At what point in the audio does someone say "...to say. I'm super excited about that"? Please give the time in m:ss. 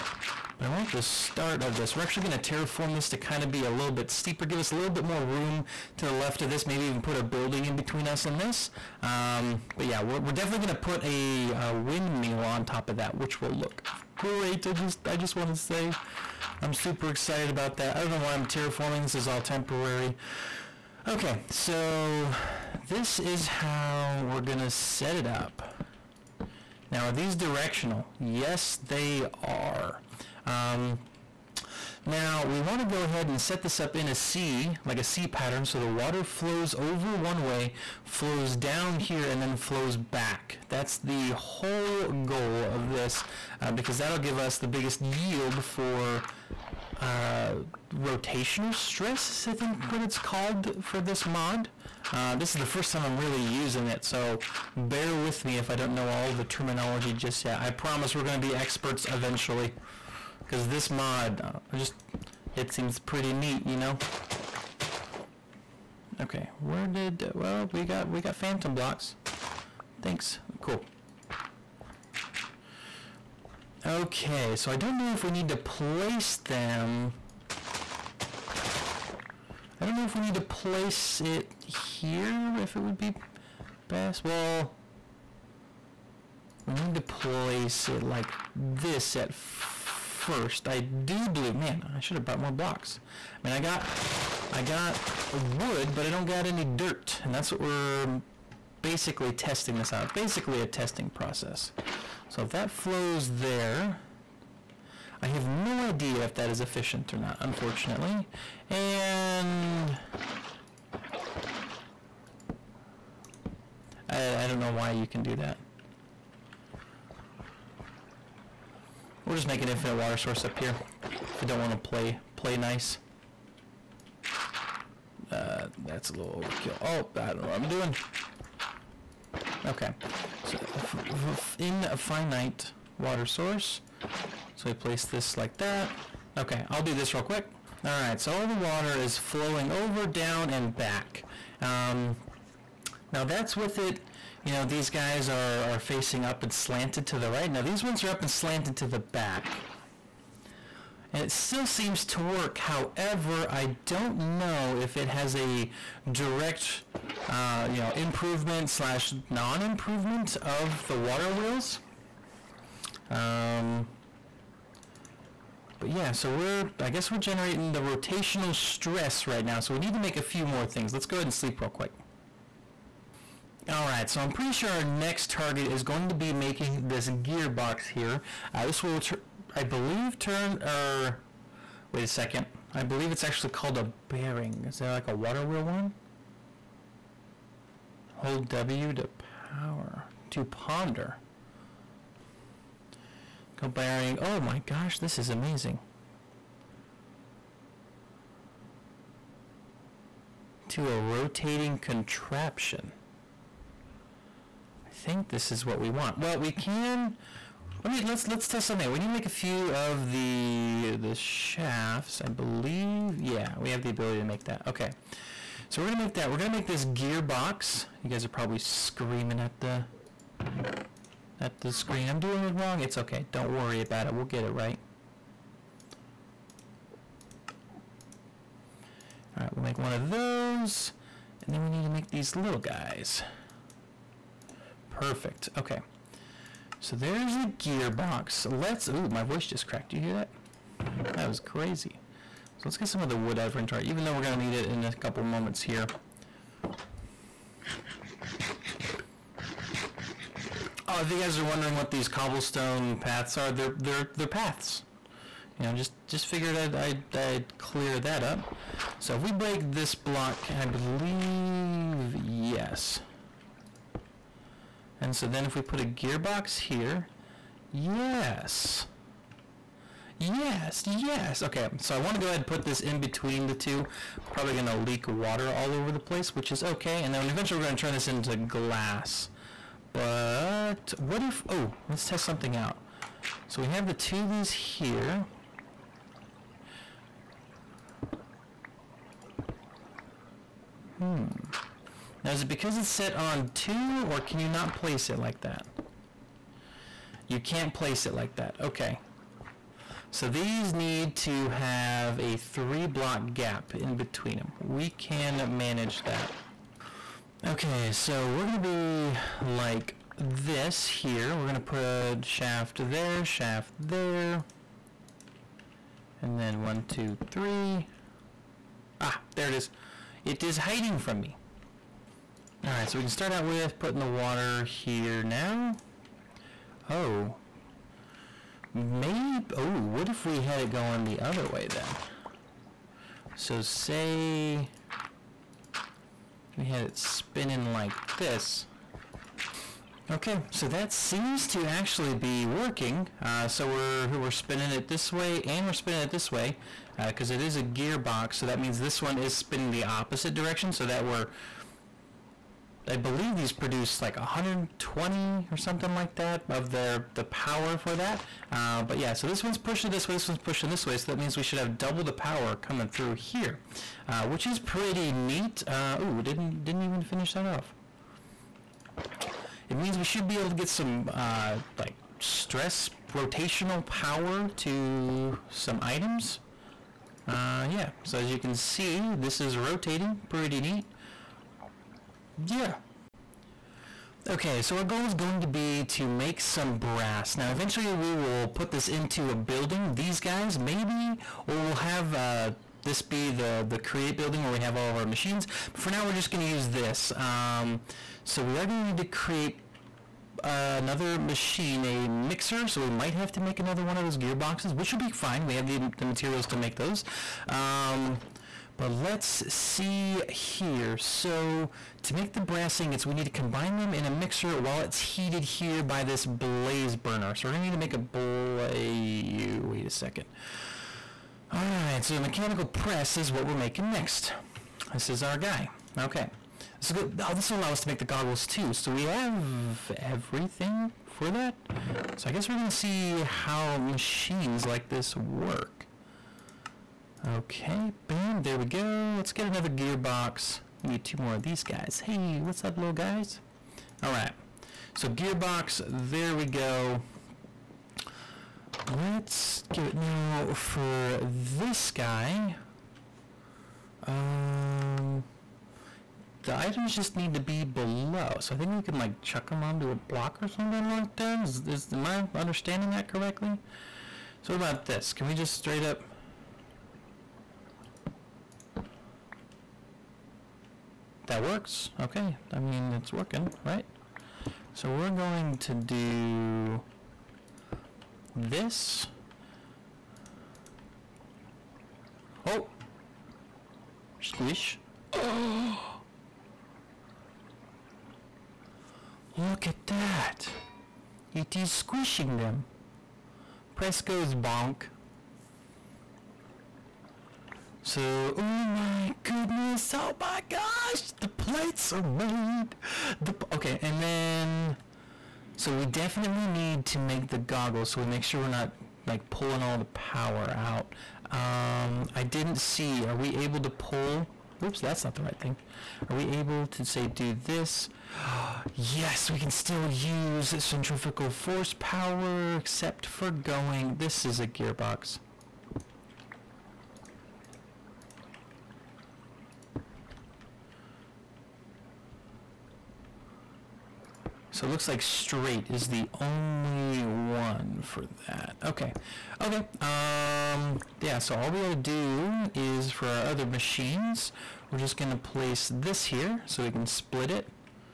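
0:15.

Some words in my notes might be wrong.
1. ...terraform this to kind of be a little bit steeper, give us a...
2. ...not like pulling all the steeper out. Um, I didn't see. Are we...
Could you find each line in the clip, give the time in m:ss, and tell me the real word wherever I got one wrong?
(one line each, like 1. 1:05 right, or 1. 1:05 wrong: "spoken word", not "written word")
1. 0:02 right
2. 8:28 wrong: "power", not "steeper".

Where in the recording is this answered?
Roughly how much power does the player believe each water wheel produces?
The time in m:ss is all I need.
5:54.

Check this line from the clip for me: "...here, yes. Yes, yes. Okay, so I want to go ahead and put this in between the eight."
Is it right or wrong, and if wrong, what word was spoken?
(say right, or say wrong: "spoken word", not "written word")
wrong: "two", not "eight".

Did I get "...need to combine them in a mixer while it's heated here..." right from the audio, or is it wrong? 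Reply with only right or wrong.
right.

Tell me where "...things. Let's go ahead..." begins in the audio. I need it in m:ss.
2:50.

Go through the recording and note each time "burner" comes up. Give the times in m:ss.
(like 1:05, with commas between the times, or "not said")
6:56.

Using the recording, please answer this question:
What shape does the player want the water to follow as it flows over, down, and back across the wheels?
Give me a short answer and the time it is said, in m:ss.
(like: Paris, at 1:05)
C pattern, at 0:34.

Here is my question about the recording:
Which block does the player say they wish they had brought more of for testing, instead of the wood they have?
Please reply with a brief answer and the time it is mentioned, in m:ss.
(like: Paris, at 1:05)
Dirt, at 1:36.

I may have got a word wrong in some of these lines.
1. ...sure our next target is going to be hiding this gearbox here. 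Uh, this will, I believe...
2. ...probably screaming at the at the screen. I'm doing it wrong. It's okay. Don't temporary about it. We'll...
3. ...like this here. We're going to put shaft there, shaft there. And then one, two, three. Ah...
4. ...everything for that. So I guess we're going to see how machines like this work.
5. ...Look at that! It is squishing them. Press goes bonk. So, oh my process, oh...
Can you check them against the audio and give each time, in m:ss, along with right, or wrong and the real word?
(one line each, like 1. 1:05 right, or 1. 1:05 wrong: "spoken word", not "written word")
1. 2:54 wrong: "making", not "hiding"
2. 3:38 wrong: "worry", not "temporary"
3. 5:09 right
4. 7:10 right
5. 8:09 wrong: "goodness", not "process".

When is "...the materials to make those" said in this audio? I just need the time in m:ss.
6:45.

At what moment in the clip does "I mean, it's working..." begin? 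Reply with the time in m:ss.
7:52.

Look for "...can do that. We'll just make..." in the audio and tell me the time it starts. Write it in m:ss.
1:55.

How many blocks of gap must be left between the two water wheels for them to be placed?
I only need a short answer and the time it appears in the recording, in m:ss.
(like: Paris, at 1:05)
3, at 5:02.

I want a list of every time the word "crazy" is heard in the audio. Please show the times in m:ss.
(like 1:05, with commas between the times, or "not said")
4:01.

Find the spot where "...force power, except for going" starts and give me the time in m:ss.
8:41.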